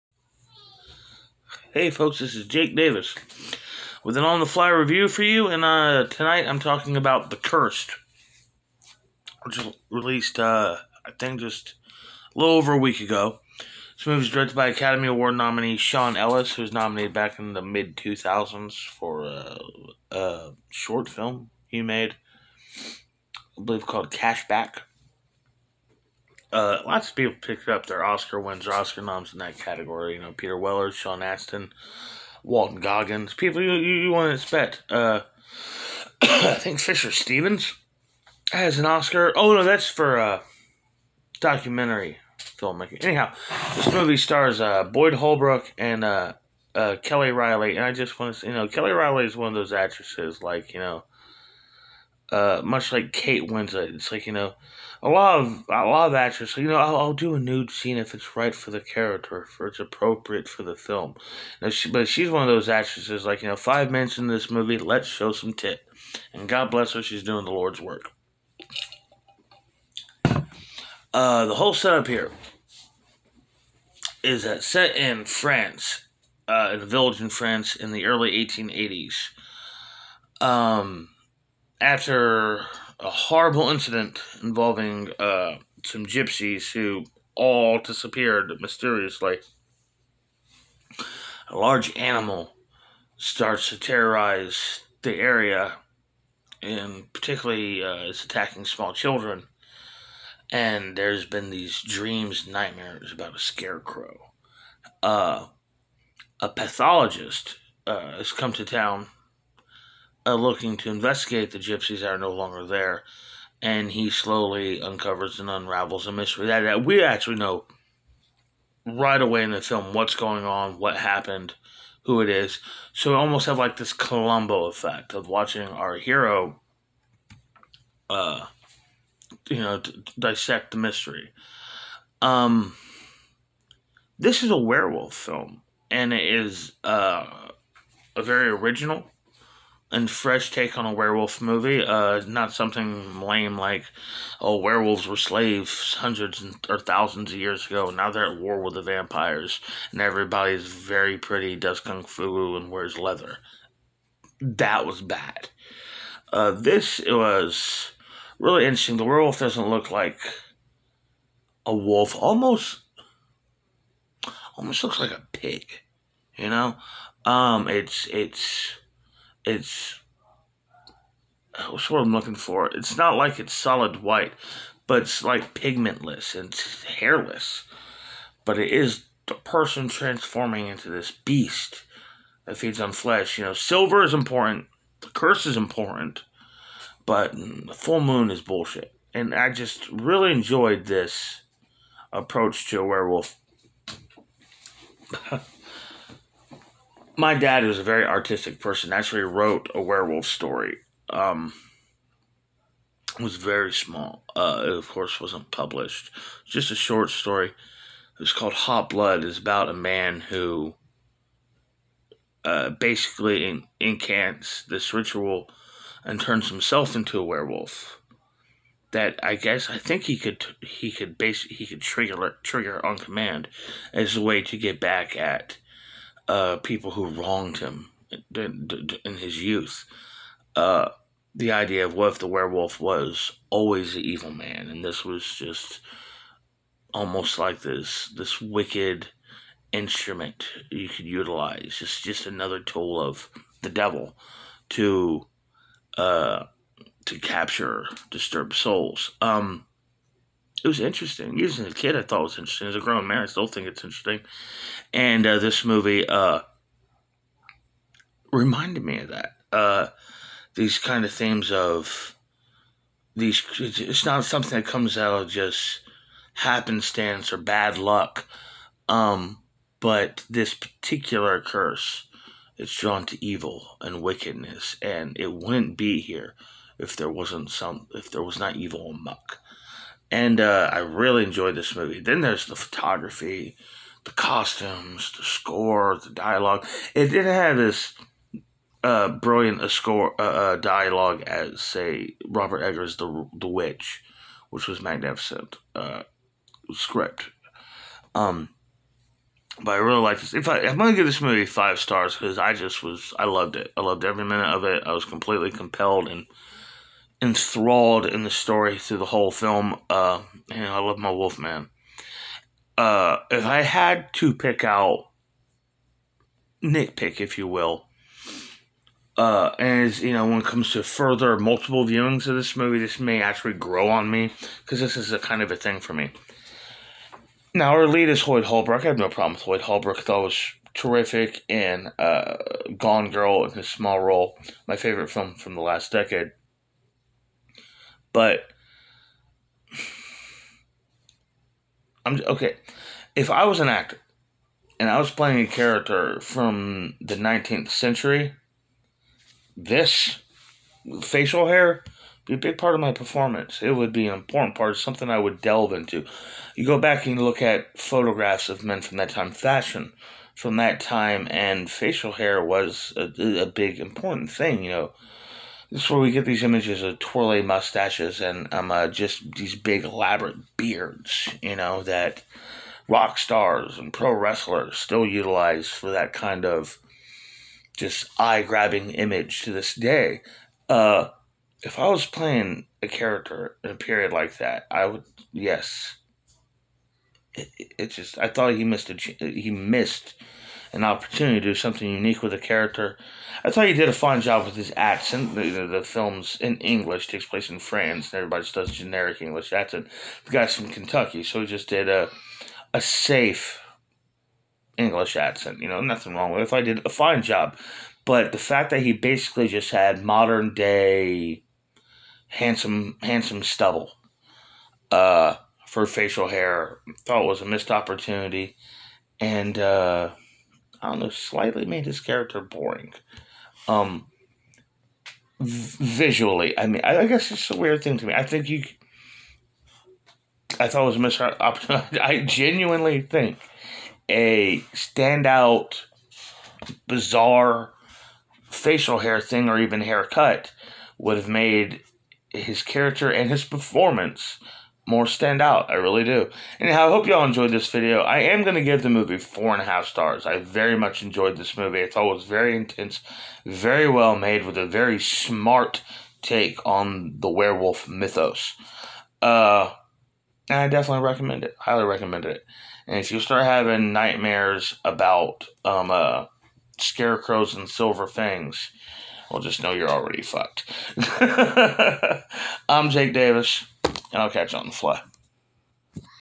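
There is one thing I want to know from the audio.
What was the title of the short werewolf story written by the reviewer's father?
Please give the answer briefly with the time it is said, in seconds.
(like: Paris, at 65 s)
Hot Blood, at 208 s.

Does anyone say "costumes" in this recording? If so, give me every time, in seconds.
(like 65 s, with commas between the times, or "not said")
284 s.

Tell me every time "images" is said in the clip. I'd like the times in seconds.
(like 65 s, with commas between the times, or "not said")
366 s, 378 s.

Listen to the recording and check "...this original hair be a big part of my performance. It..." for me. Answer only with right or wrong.
wrong.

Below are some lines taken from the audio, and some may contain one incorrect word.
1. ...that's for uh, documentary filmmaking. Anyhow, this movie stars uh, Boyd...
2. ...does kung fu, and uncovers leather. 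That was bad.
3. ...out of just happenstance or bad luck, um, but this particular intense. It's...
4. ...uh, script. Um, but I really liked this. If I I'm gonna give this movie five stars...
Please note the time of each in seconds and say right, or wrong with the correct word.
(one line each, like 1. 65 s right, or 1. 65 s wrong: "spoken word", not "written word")
1. 39 s right
2. 151 s wrong: "wears", not "uncovers"
3. 264 s wrong: "curse", not "intense"
4. 295 s right.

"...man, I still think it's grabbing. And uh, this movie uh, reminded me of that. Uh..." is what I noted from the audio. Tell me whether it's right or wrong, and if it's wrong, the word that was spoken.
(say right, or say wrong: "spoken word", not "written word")
wrong: "interesting", not "grabbing".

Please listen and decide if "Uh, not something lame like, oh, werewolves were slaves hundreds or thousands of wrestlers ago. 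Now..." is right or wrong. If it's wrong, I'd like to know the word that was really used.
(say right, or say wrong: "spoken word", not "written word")
wrong: "years", not "wrestlers".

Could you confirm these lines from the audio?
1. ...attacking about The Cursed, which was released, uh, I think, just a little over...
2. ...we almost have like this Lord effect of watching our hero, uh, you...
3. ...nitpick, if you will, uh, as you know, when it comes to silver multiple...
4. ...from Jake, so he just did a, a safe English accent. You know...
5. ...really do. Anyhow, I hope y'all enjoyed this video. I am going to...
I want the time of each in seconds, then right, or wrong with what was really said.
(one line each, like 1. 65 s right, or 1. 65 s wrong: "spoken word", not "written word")
1. 6 s wrong: "talking", not "attacking"
2. 123 s wrong: "Columbo", not "Lord"
3. 316 s wrong: "further", not "silver"
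4. 400 s wrong: "Kentucky", not "Jake"
5. 445 s right.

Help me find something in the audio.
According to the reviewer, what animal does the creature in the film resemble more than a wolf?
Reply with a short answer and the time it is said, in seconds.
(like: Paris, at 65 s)
a pig, at 165 s.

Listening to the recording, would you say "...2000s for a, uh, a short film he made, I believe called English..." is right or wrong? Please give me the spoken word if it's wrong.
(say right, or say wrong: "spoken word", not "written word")
wrong: "Cashback", not "English".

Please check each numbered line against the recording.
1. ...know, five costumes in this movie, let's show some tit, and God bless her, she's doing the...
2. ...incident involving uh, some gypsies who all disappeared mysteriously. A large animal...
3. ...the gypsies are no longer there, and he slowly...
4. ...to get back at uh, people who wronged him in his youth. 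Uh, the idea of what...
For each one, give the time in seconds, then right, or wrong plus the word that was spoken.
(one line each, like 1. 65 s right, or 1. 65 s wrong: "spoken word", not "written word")
1. 63 s wrong: "minutes", not "costumes"
2. 83 s right
3. 111 s right
4. 224 s right.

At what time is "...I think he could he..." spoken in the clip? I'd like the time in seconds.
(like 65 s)
219 s.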